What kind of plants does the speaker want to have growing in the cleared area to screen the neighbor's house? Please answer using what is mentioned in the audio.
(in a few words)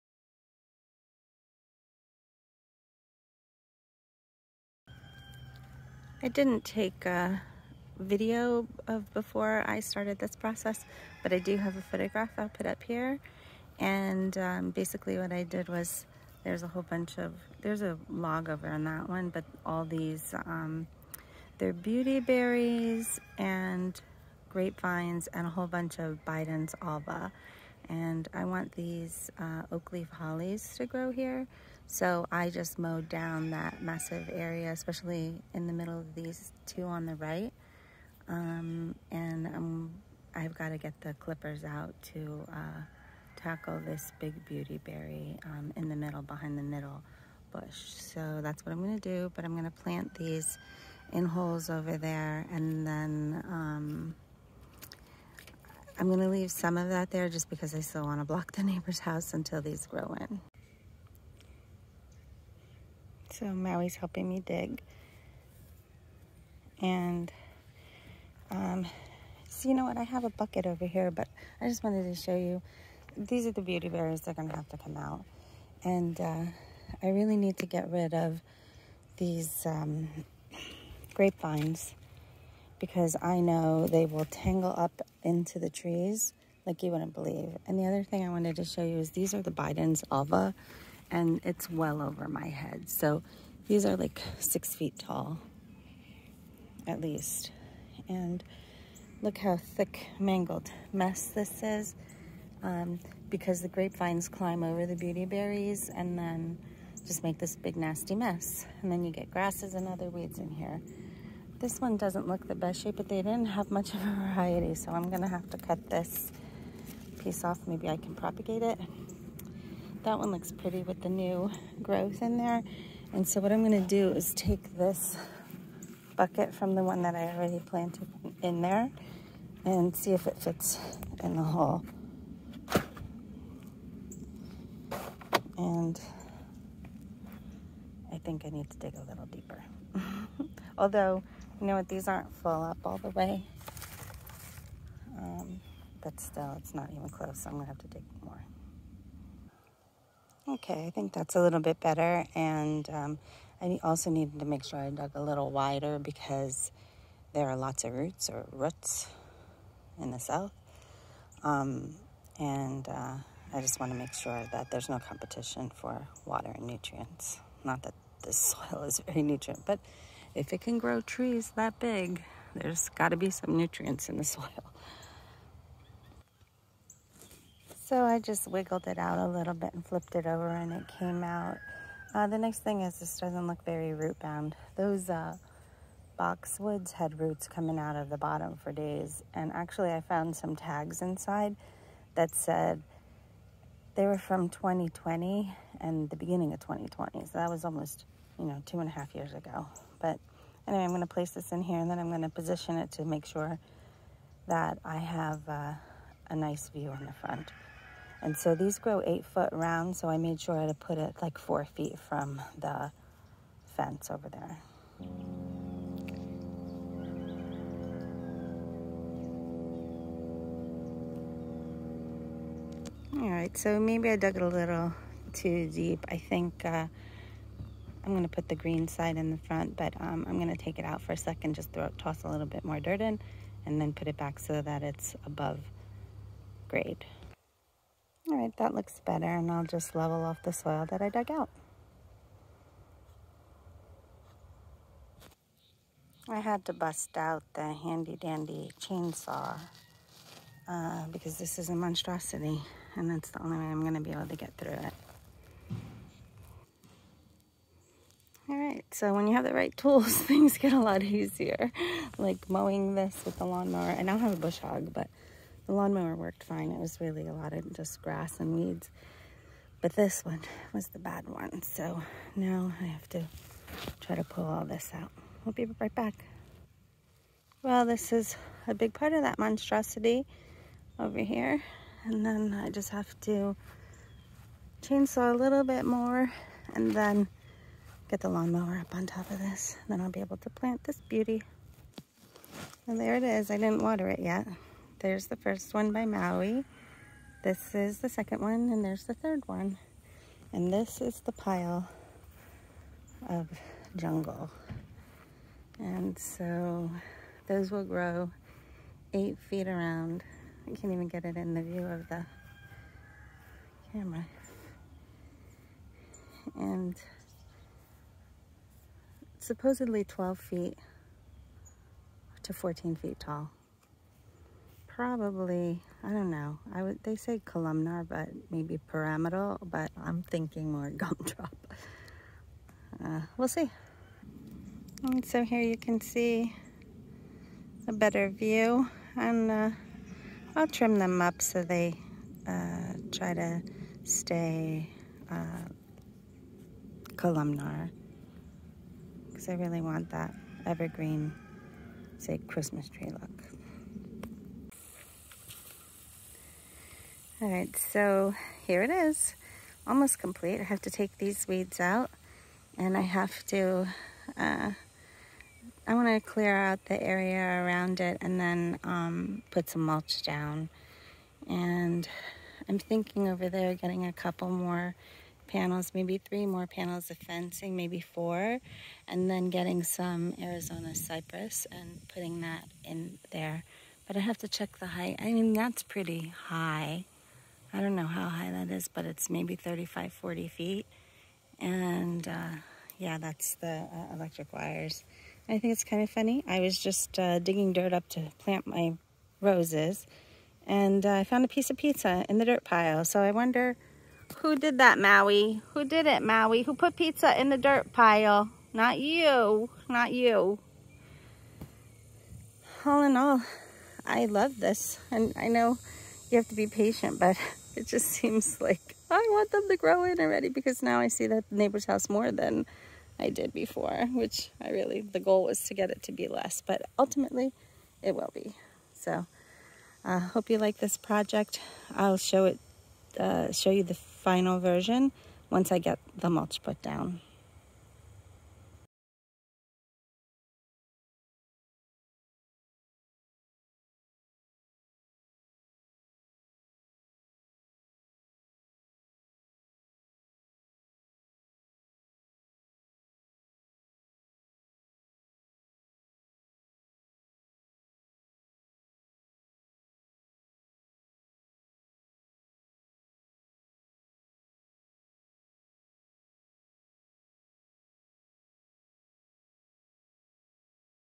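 oak leaf hollies.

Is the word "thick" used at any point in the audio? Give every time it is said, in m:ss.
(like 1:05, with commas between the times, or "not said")
1:39.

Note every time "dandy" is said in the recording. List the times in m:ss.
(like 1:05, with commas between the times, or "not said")
4:07.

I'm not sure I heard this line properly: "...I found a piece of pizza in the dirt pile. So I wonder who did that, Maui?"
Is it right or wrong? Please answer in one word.
right.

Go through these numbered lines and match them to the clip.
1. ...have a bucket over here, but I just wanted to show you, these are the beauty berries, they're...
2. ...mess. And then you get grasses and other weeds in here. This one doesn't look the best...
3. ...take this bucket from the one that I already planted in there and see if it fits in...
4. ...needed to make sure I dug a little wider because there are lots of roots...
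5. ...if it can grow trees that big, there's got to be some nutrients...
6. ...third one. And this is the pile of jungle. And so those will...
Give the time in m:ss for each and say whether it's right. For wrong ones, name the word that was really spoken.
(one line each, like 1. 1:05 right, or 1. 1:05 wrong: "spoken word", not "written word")
1. 1:10 right
2. 1:48 right
3. 2:04 right
4. 2:34 right
5. 2:50 right
6. 4:59 right.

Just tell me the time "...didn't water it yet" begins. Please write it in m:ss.
4:53.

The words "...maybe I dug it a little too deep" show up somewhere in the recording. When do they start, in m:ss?
3:43.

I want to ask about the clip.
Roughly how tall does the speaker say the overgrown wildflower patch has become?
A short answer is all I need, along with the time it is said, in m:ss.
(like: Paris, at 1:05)
6 feet, at 1:34.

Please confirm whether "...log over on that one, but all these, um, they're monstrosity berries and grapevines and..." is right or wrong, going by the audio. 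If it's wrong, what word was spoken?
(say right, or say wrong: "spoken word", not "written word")
wrong: "beauty", not "monstrosity".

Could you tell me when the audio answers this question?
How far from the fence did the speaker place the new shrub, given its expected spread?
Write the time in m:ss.
3:31.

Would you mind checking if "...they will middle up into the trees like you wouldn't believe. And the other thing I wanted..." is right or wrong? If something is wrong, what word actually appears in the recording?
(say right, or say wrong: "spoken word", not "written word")
wrong: "tangle", not "middle".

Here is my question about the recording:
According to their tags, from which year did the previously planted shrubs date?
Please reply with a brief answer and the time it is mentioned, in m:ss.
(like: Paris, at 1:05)
2020, at 3:16.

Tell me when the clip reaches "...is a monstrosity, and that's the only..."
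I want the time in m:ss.
4:11.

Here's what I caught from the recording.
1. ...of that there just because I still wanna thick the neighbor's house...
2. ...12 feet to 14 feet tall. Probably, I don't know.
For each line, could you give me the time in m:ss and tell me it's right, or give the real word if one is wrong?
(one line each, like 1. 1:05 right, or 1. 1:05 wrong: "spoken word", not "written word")
1. 0:56 wrong: "block", not "thick"
2. 5:20 right.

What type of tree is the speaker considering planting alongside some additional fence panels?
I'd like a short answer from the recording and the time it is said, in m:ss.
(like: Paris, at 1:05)
Arizona cypress, at 6:20.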